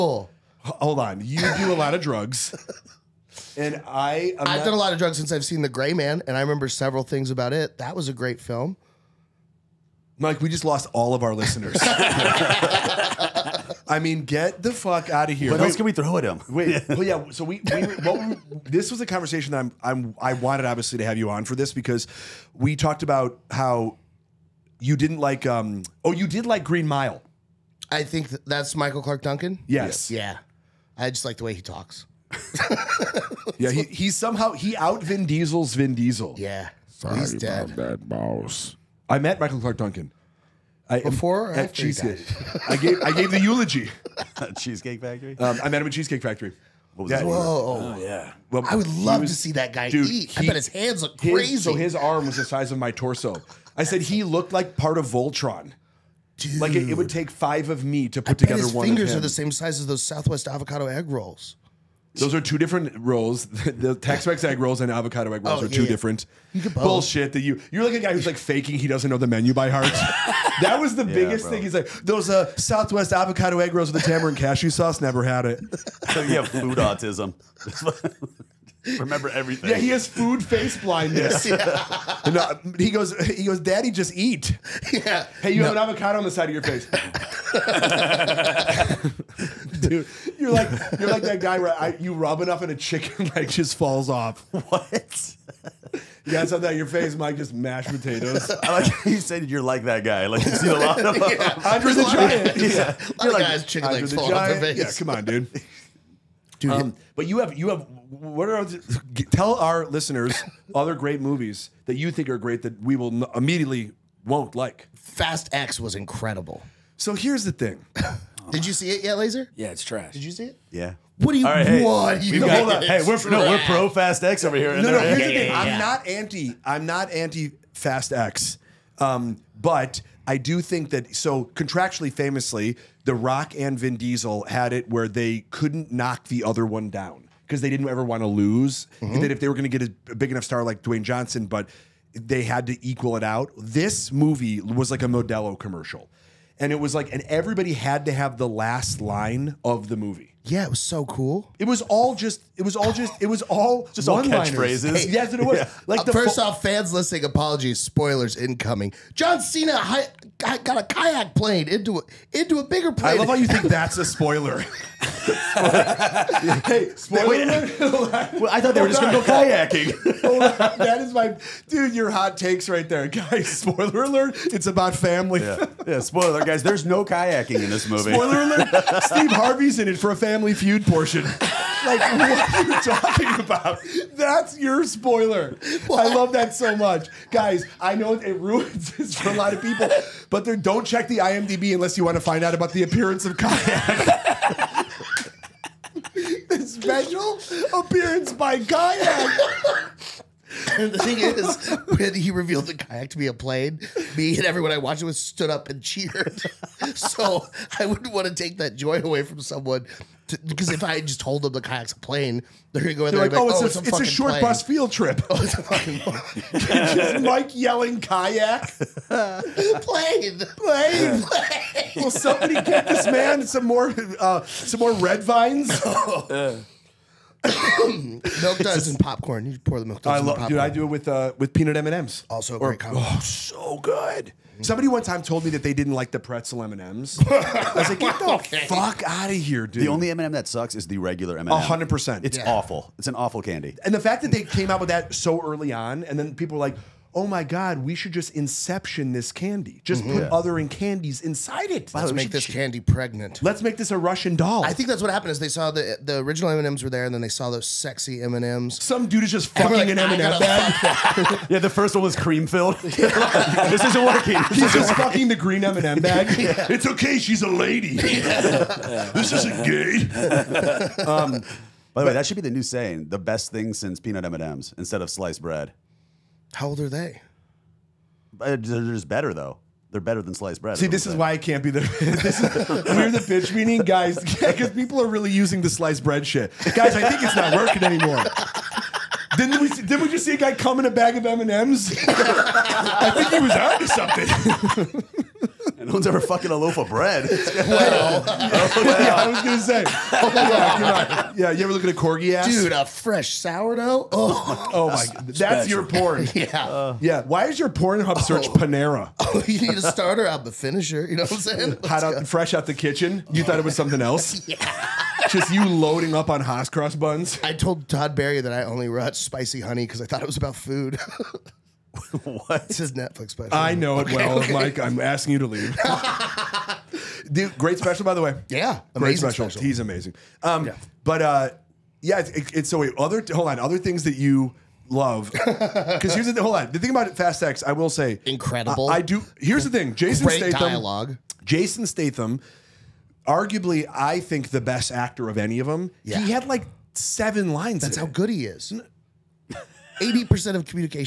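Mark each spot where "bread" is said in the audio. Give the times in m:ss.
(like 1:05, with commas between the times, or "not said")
4:35, 4:40, 4:46, 4:56.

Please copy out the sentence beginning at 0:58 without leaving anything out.
Fingers are the same size as those Southwest avocado egg rolls.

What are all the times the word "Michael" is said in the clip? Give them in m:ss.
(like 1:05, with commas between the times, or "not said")
0:28, 0:39.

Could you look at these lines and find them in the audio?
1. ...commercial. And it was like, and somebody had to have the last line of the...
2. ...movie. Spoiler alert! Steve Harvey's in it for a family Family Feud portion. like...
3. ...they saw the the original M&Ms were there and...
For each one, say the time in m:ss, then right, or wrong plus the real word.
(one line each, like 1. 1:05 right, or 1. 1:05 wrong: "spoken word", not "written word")
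1. 2:25 wrong: "everybody", not "somebody"
2. 2:57 right
3. 4:15 right.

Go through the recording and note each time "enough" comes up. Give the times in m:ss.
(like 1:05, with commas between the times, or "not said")
1:32, 2:20.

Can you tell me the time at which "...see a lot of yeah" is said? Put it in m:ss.
1:40.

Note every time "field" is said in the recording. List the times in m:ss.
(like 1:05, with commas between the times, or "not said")
3:34.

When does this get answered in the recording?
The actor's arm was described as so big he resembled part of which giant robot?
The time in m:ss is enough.
0:55.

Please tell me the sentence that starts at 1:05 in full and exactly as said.
different bullshit that you you're like a guy who's like faking he doesn't know the menu by heart.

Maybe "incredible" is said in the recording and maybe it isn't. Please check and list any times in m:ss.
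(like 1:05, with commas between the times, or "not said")
1:55, 5:38.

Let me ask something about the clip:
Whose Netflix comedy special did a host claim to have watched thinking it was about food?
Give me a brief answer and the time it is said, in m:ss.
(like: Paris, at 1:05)
Todd Barry, at 5:17.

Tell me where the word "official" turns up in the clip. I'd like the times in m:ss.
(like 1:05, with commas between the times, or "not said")
not said.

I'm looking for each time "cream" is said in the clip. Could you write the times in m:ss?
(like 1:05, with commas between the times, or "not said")
4:22.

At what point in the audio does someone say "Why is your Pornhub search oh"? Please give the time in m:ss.
5:07.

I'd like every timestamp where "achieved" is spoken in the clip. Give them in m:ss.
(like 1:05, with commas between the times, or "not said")
not said.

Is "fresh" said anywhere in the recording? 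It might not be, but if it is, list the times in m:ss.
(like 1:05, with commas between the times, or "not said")
5:02, 5:12.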